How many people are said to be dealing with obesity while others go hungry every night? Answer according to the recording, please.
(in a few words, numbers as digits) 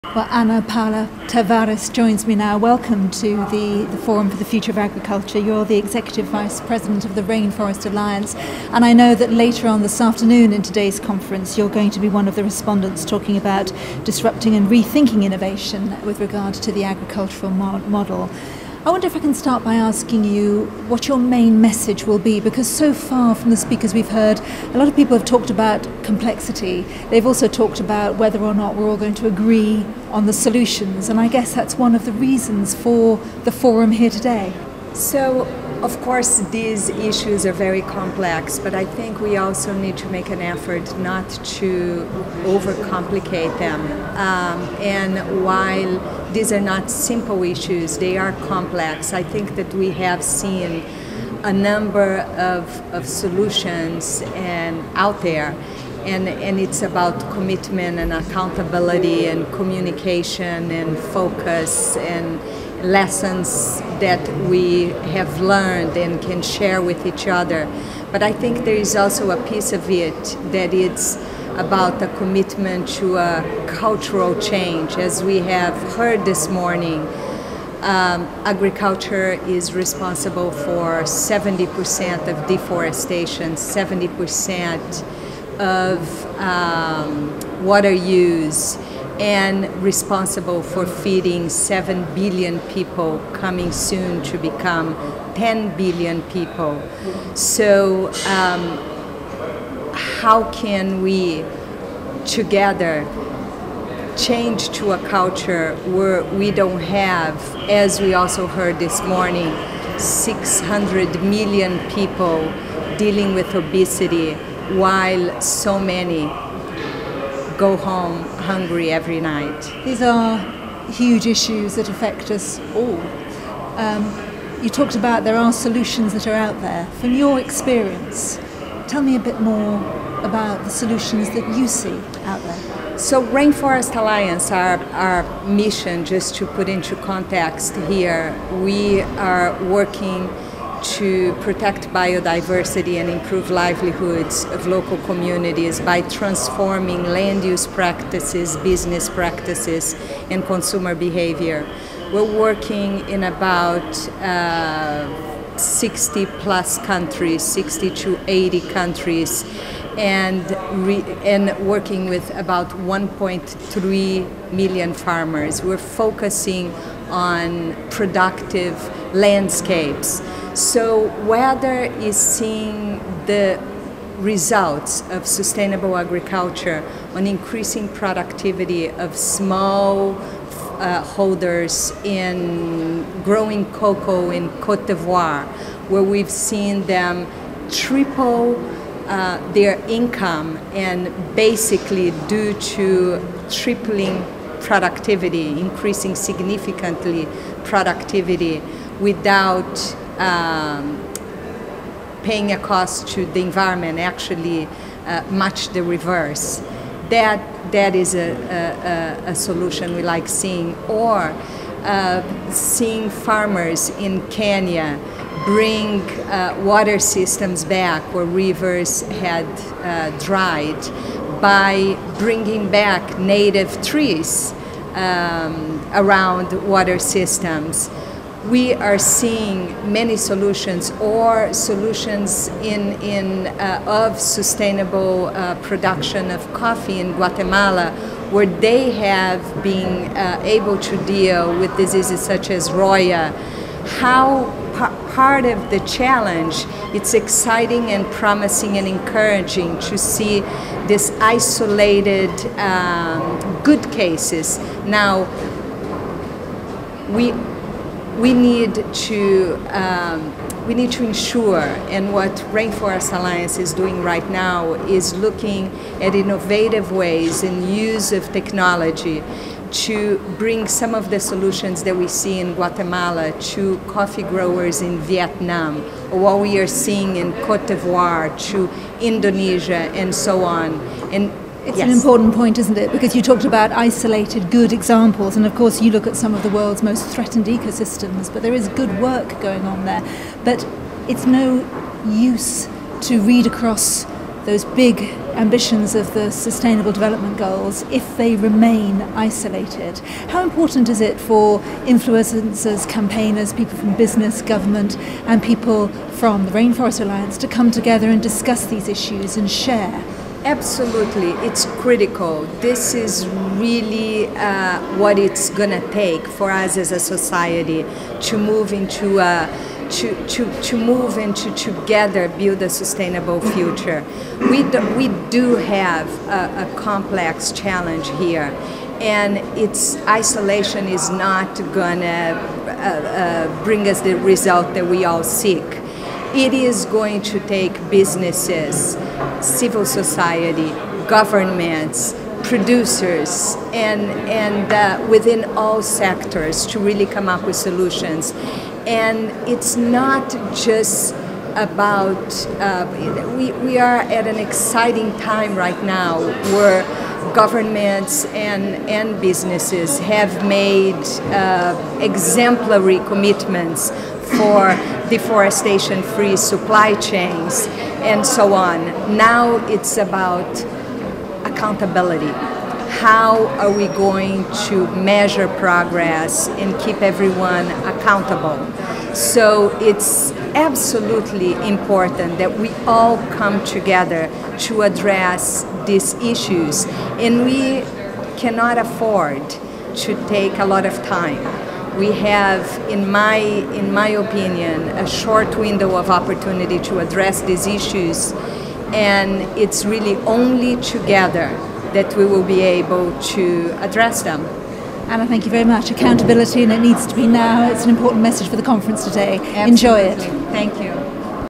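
600 million.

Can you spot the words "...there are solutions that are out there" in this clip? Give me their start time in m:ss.
2:05.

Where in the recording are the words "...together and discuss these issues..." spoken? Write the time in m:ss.
5:07.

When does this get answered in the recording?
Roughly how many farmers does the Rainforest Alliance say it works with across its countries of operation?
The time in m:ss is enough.
2:42.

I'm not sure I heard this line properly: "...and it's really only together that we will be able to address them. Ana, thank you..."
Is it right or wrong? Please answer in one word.
right.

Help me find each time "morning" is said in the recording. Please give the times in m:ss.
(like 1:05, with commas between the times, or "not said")
1:16, 1:49.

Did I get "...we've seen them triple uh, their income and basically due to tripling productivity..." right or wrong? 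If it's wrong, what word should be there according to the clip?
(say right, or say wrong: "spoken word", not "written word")
right.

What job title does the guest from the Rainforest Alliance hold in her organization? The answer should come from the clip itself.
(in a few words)
Executive Vice President.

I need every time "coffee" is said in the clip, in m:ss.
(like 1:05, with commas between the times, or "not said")
3:56, 4:33.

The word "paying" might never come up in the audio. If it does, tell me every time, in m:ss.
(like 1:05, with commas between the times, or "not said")
3:22.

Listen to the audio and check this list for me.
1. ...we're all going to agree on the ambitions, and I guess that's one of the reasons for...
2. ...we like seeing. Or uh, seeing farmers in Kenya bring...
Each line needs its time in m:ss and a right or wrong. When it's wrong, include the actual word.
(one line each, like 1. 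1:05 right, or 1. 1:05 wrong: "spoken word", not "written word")
1. 0:28 wrong: "solutions", not "ambitions"
2. 3:29 right.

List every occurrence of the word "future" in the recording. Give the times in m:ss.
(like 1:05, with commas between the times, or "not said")
0:04, 5:23.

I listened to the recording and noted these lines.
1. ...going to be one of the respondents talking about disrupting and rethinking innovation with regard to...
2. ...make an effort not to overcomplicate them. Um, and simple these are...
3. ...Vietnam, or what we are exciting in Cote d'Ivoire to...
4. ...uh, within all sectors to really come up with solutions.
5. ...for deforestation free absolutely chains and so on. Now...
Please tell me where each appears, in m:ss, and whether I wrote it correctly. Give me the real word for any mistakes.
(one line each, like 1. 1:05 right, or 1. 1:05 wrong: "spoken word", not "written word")
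1. 0:11 right
2. 0:40 wrong: "while", not "simple"
3. 4:34 wrong: "seeing", not "exciting"
4. 5:44 right
5. 6:04 wrong: "supply", not "absolutely".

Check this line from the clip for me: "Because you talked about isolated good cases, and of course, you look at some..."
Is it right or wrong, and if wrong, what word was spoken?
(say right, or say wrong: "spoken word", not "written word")
wrong: "examples", not "cases".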